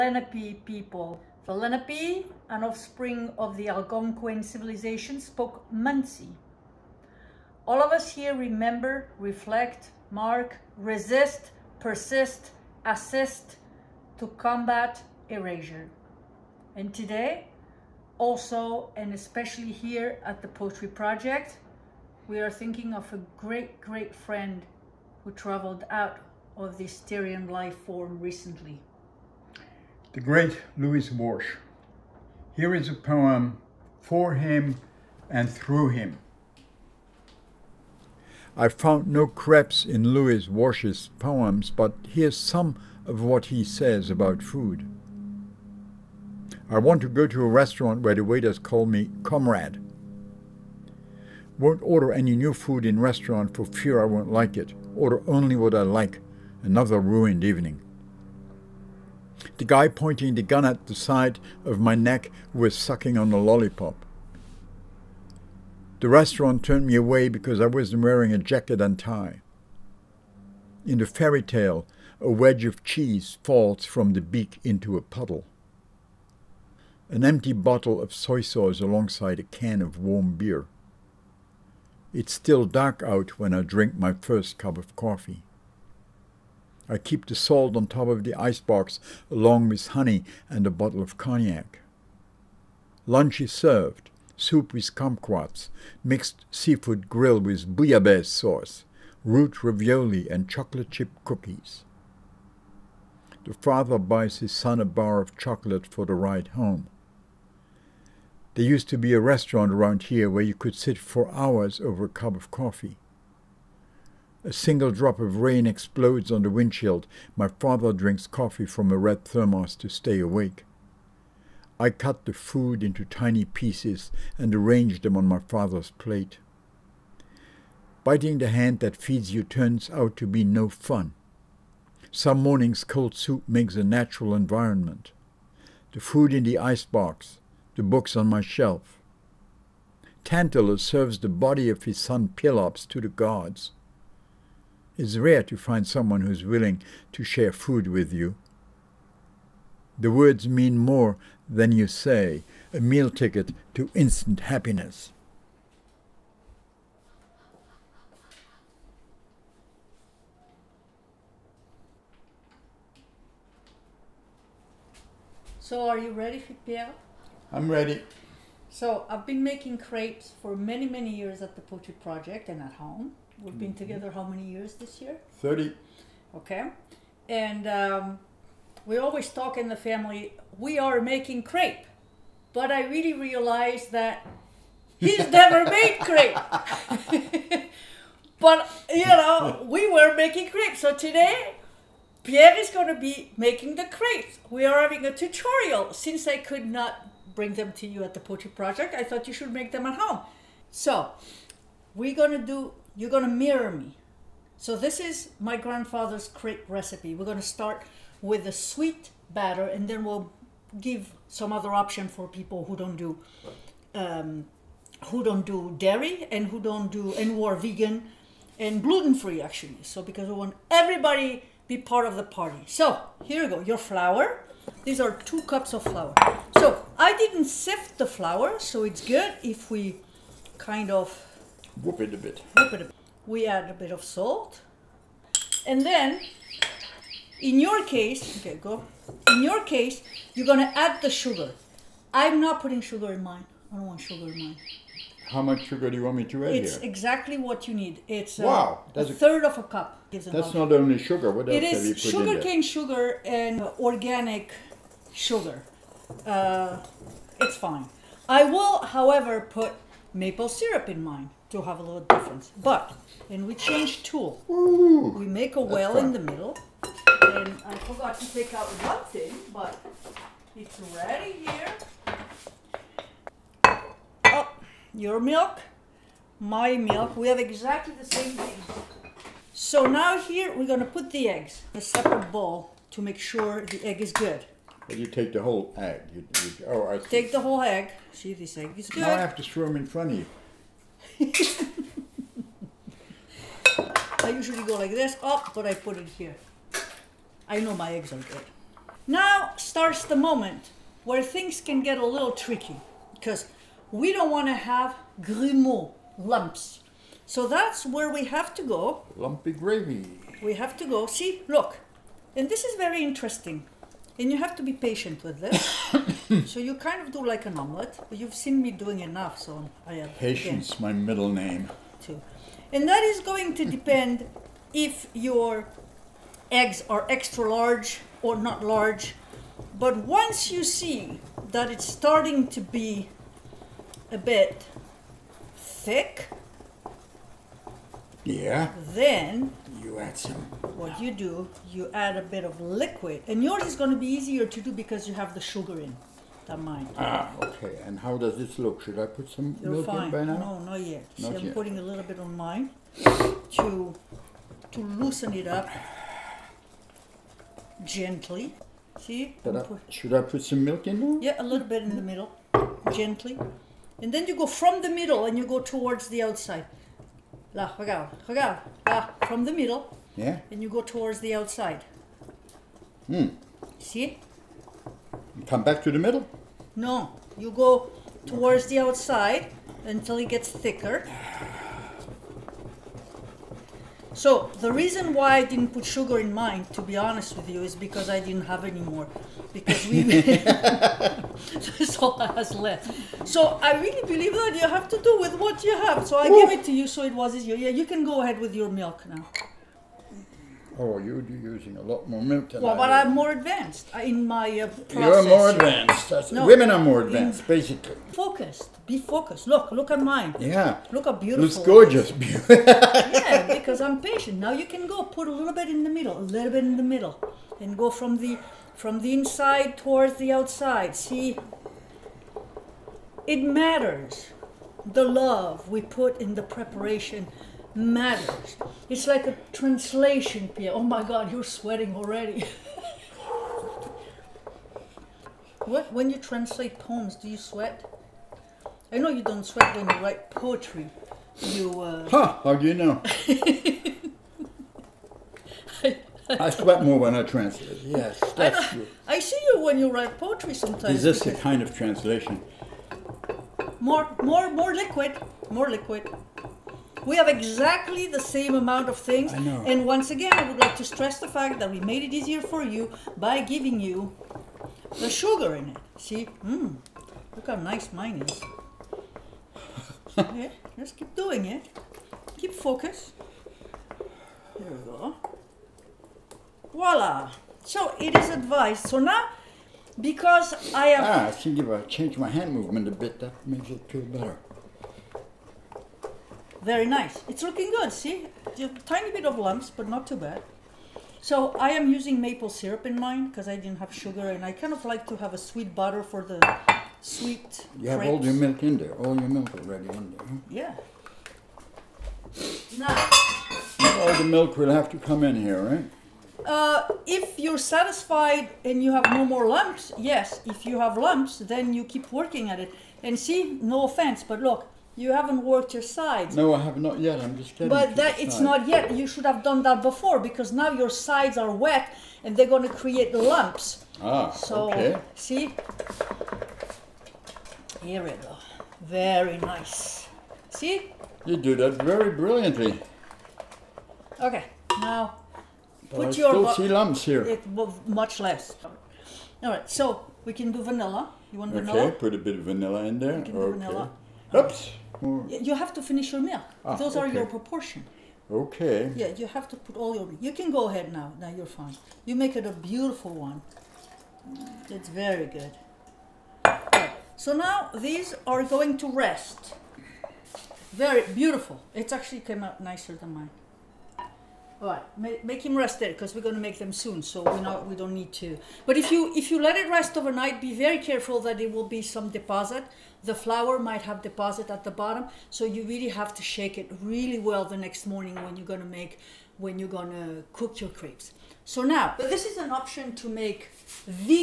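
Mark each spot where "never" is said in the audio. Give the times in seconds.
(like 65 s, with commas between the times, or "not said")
185 s.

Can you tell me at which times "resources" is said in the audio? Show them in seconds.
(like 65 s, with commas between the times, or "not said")
not said.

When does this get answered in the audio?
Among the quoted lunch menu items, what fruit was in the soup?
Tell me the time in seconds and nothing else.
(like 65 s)
94 s.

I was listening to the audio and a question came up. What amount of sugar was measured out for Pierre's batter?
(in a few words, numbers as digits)
a third of a cup.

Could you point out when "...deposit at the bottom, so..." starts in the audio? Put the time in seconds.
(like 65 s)
574 s.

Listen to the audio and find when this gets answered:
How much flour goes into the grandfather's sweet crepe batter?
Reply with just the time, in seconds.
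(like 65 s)
225 s.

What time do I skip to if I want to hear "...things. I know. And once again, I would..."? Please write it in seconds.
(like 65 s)
458 s.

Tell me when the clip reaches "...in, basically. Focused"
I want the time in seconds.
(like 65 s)
407 s.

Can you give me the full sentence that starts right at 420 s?
See, it matters the love we put in the preparation matters.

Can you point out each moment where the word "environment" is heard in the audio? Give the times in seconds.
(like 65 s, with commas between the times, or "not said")
134 s.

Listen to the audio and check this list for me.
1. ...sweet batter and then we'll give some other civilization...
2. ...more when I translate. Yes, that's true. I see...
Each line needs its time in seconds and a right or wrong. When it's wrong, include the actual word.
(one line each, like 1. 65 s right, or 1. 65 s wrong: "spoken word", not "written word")
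1. 208 s wrong: "option", not "civilization"
2. 446 s right.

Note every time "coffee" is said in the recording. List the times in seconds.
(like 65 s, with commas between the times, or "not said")
84 s, 112 s, 118 s.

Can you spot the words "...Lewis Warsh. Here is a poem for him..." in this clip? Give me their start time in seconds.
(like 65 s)
30 s.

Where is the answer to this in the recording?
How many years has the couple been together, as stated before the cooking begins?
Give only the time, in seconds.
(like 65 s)
175 s.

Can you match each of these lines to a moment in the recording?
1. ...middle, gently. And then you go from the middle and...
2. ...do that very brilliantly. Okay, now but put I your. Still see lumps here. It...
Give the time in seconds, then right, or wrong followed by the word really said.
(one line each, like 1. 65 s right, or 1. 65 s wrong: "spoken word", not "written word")
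1. 362 s right
2. 531 s right.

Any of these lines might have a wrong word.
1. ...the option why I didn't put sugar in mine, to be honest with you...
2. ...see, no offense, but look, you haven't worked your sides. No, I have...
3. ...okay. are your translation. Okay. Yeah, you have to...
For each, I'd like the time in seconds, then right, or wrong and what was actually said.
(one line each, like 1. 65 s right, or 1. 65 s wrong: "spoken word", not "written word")
1. 384 s wrong: "reason", not "option"
2. 513 s right
3. 546 s wrong: "proportion", not "translation".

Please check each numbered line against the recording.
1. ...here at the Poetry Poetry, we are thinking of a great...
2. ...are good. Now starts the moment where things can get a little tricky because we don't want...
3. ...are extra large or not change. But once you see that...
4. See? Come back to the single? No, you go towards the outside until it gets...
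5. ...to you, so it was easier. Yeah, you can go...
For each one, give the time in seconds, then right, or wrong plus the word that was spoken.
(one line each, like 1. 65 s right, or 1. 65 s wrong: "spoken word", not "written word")
1. 19 s wrong: "Project", not "Poetry"
2. 298 s right
3. 326 s wrong: "large", not "change"
4. 373 s wrong: "middle", not "single"
5. 396 s right.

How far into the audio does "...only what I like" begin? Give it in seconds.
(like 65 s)
55 s.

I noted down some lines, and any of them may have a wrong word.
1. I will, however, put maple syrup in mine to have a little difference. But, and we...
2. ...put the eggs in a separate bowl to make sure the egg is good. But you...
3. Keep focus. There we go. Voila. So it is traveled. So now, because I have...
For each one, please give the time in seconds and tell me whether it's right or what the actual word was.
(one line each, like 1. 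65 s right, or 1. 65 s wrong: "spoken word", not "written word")
1. 258 s right
2. 280 s right
3. 472 s wrong: "advised", not "traveled".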